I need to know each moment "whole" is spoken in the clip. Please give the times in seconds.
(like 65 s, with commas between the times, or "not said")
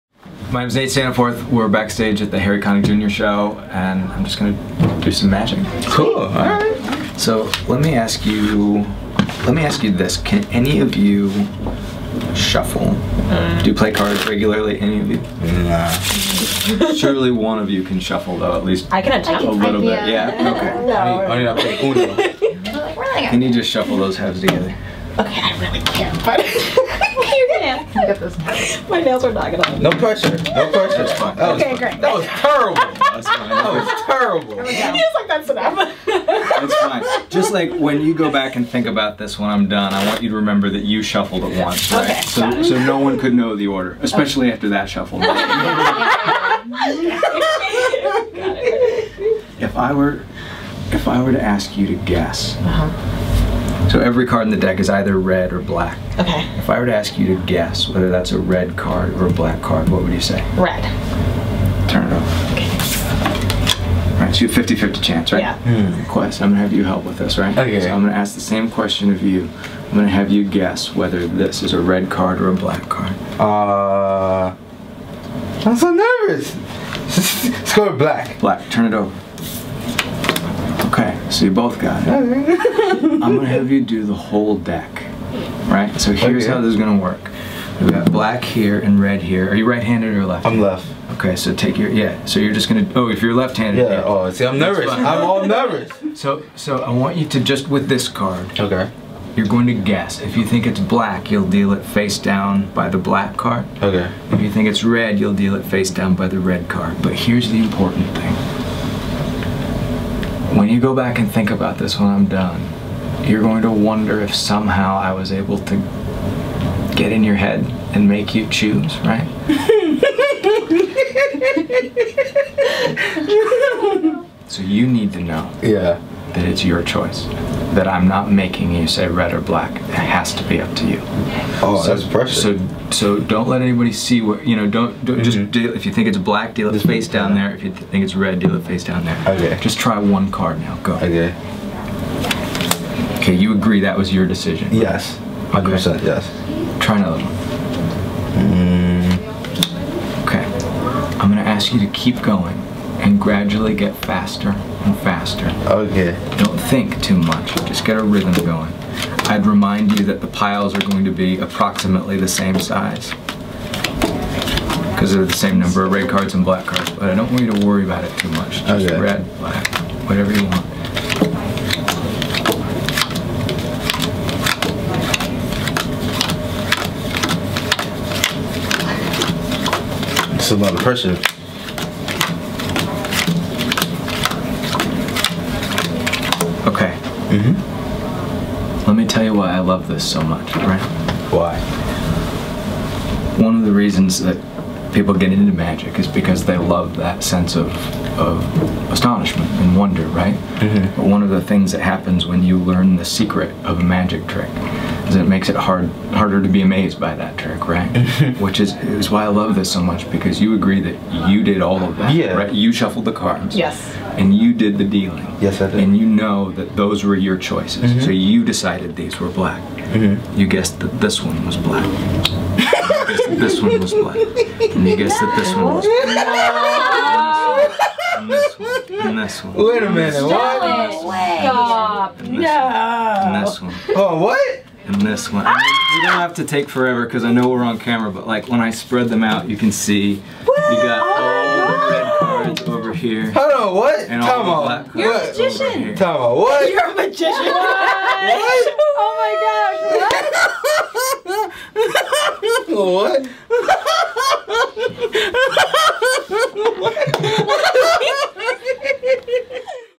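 84 s.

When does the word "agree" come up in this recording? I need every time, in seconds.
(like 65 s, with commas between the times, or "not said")
143 s, 210 s.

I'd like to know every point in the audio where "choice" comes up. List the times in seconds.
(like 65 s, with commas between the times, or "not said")
126 s, 217 s.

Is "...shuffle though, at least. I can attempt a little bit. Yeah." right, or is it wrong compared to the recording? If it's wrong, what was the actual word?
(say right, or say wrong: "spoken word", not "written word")
right.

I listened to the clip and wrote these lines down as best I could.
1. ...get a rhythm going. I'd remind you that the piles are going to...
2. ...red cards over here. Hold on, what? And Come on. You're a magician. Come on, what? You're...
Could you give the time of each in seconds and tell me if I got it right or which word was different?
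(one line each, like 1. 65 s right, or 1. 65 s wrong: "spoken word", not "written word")
1. 157 s right
2. 242 s right.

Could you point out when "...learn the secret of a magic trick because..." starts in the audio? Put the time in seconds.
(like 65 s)
202 s.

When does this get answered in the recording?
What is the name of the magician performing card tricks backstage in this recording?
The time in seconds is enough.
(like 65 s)
0 s.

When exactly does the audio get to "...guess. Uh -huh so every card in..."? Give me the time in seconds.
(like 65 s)
52 s.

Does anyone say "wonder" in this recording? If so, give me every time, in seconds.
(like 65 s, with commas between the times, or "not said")
113 s, 199 s.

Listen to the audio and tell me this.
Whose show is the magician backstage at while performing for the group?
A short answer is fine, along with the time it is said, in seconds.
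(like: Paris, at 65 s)
Harry Connick Jr., at 2 s.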